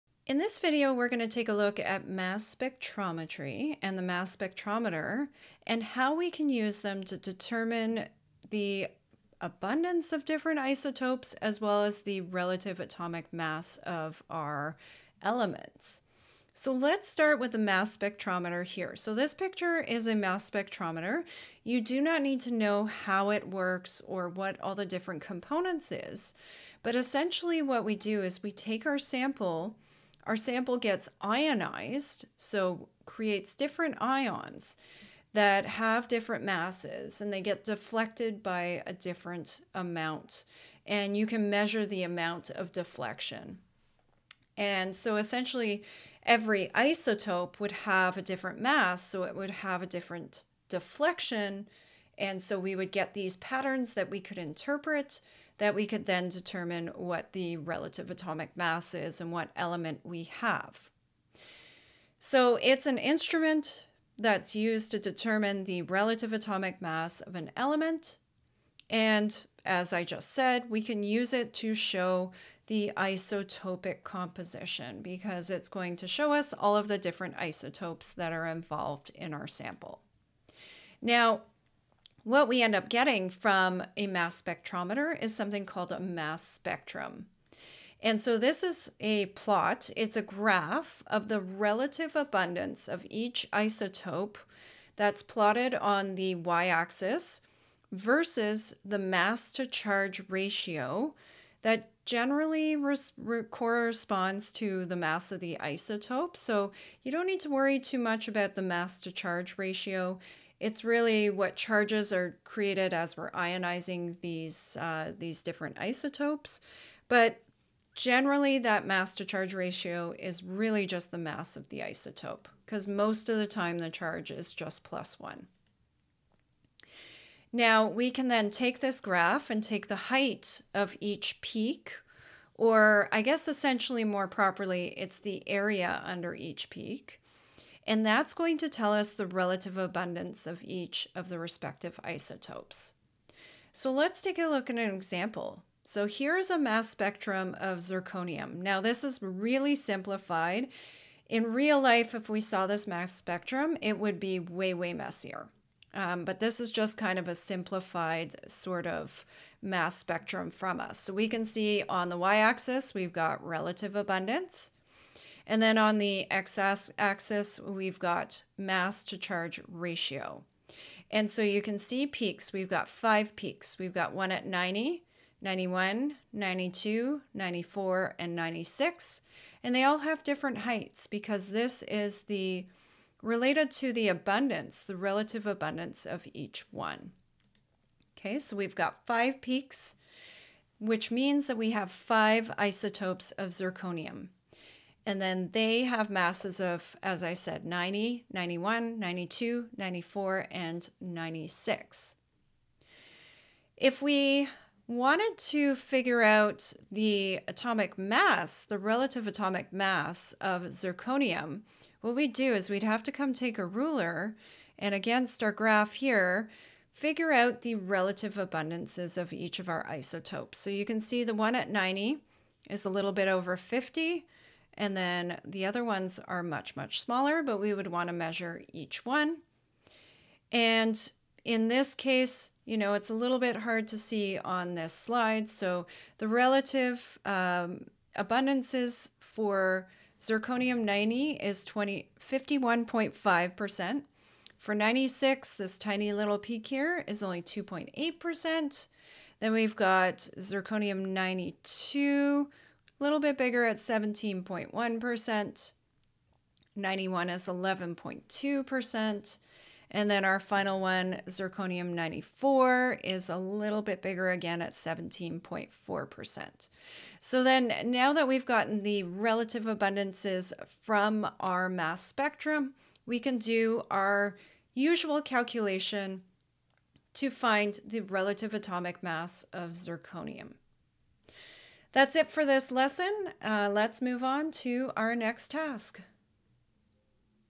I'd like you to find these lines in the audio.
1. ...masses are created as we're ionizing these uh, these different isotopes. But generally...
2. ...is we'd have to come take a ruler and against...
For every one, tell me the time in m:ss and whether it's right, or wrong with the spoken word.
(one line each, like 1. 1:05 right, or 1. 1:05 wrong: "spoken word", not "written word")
1. 1:51 wrong: "charges", not "masses"
2. 3:32 right.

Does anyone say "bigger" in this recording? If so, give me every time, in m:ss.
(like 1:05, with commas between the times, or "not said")
4:13, 4:24.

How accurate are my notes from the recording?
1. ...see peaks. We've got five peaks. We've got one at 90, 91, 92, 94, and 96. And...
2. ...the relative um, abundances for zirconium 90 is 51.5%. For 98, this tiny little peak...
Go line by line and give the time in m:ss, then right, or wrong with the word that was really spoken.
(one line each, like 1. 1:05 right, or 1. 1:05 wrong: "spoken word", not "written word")
1. 2:51 right
2. 3:56 wrong: "96", not "98".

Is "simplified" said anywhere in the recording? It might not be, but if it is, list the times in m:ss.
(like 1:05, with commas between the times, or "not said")
2:29, 2:37.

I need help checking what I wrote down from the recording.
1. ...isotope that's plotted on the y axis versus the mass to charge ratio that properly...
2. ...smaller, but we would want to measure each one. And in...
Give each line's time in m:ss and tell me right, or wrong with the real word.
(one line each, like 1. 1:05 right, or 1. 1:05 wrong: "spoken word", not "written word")
1. 1:33 wrong: "generally", not "properly"
2. 3:47 right.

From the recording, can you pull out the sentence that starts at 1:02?
So it's an instrument that's used to determine the relative atomic mass of an element.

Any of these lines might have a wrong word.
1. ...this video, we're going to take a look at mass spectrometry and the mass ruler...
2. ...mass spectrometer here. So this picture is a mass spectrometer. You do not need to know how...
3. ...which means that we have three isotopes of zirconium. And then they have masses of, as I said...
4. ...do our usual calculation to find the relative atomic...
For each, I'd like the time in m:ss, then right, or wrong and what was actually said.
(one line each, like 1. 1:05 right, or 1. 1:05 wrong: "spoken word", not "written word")
1. 0:00 wrong: "spectrometer", not "ruler"
2. 0:17 right
3. 3:10 wrong: "five", not "three"
4. 4:33 right.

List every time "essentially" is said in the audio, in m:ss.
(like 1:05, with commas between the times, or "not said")
0:26, 0:45, 2:13.